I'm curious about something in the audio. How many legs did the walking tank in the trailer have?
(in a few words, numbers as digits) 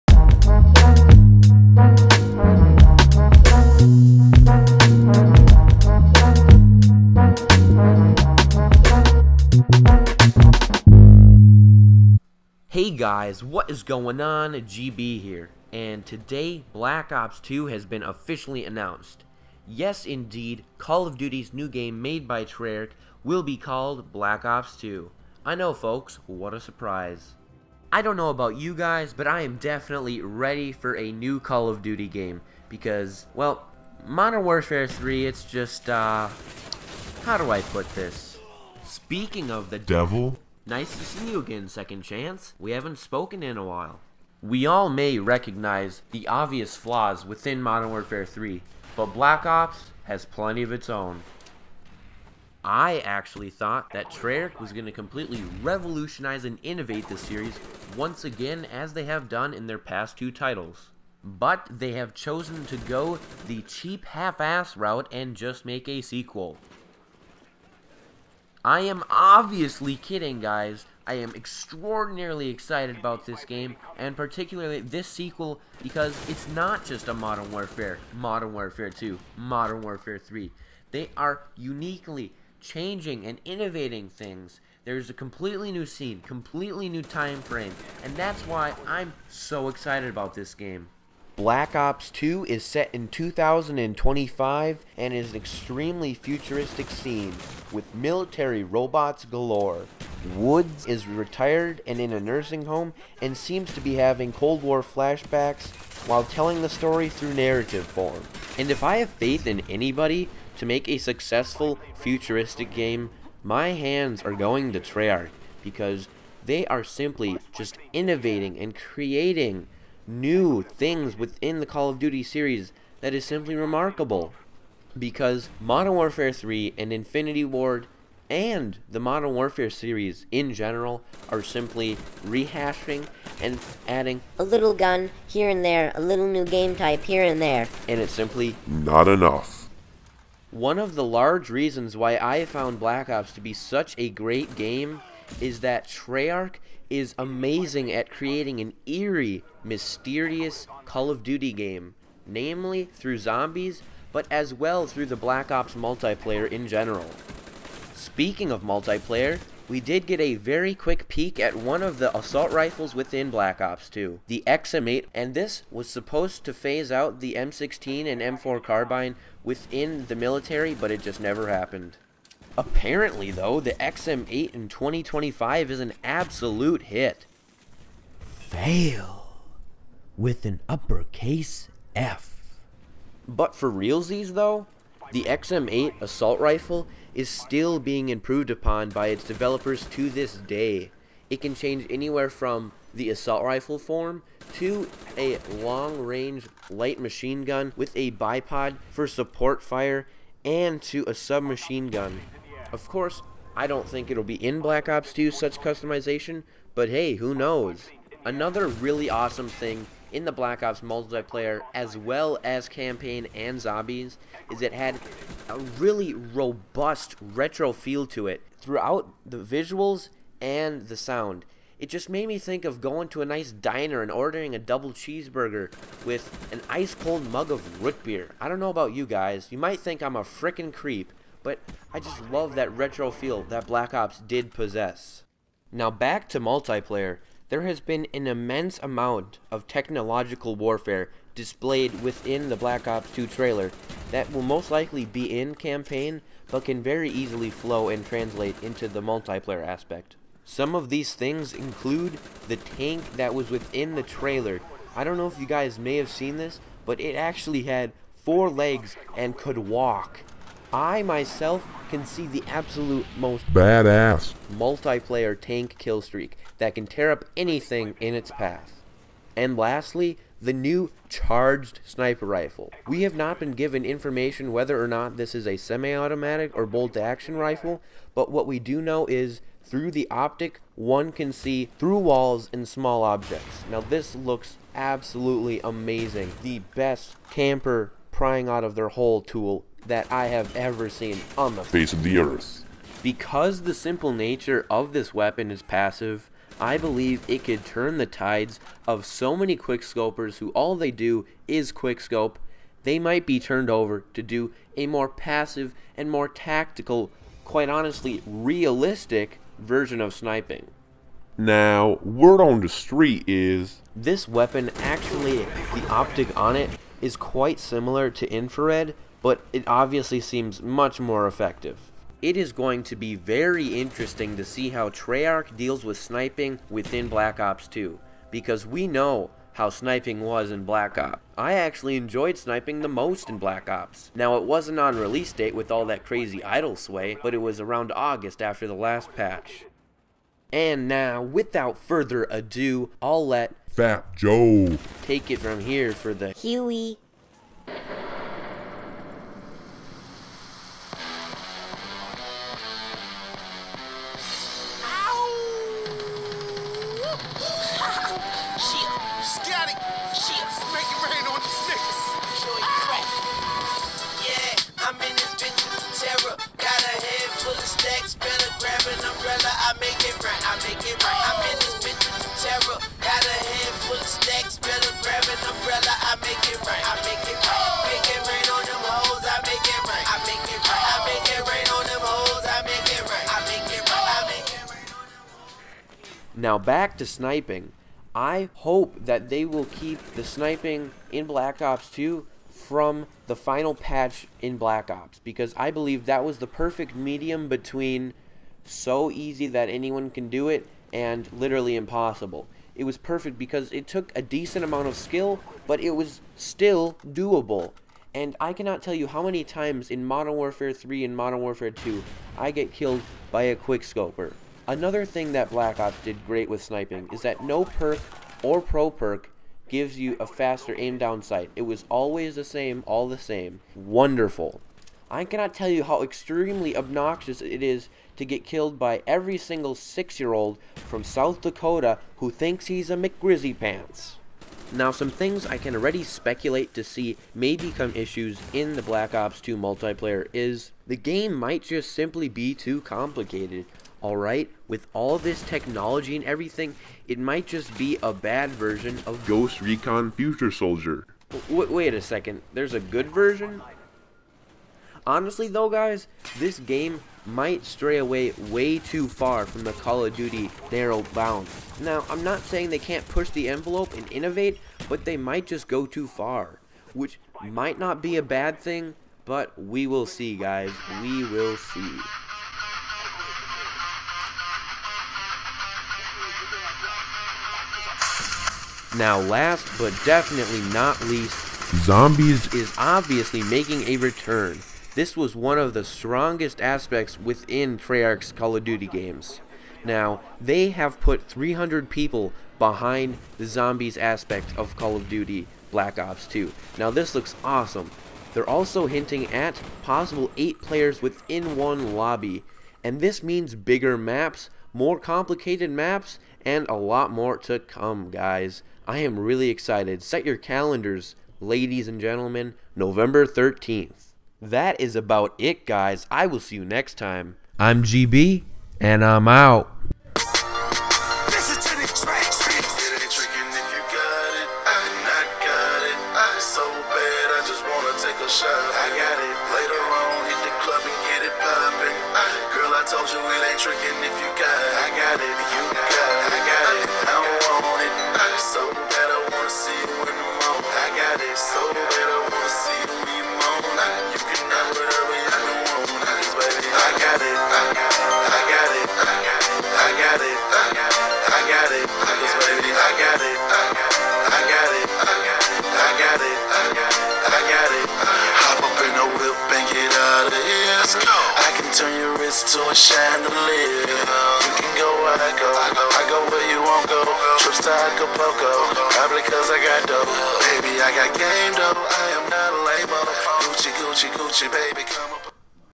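4.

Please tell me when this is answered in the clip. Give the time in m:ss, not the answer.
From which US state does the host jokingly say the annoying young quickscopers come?
7:11.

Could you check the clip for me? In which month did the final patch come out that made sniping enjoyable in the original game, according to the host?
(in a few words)
August.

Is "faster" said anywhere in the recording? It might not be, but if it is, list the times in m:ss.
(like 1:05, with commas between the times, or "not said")
7:00.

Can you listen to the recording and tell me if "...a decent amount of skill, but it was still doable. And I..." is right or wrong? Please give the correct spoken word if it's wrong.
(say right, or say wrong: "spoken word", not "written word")
right.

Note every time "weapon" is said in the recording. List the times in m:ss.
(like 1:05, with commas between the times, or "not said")
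4:55, 5:14.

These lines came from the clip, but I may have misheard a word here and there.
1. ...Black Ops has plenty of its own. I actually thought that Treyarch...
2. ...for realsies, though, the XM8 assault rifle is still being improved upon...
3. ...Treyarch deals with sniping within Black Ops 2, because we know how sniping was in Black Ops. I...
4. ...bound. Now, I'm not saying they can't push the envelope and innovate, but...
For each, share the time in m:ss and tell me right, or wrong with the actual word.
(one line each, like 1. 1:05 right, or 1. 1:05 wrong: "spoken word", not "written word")
1. 0:49 right
2. 3:03 right
3. 5:24 right
4. 7:41 right.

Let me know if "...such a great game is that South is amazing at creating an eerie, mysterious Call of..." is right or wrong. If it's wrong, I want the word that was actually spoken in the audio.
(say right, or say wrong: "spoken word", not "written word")
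wrong: "Treyarch", not "South".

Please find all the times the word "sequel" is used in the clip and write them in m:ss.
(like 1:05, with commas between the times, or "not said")
1:06, 1:15.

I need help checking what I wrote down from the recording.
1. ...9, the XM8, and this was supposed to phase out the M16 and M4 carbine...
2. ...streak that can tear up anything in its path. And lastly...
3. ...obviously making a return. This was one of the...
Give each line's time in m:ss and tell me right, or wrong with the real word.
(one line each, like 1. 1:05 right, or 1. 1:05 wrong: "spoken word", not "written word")
1. 2:43 wrong: "2", not "9"
2. 4:26 right
3. 8:02 right.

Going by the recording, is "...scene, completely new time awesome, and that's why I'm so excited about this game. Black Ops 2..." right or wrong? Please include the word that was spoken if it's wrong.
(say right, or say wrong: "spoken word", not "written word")
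wrong: "frame", not "awesome".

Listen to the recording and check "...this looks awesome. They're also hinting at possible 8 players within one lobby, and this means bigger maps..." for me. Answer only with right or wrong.
right.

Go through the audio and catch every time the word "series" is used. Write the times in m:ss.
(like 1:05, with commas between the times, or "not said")
0:57, 2:02, 2:09.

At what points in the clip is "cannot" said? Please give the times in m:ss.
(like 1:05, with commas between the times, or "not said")
6:48, 7:05.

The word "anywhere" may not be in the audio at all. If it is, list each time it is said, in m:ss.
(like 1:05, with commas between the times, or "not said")
3:11.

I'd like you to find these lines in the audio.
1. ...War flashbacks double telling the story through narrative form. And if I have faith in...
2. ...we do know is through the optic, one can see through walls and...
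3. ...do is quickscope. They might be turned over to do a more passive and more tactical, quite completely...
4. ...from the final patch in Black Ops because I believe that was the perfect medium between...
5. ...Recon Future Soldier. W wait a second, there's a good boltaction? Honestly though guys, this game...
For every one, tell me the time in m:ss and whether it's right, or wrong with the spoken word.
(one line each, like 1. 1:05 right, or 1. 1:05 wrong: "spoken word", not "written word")
1. 1:44 wrong: "while", not "double"
2. 4:38 right
3. 5:00 wrong: "honestly", not "completely"
4. 6:32 right
5. 7:29 wrong: "version", not "boltaction".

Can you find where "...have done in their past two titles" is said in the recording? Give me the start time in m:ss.
0:59.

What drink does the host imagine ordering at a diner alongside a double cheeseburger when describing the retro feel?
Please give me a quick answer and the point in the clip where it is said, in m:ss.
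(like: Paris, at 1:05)
Root beer, at 3:47.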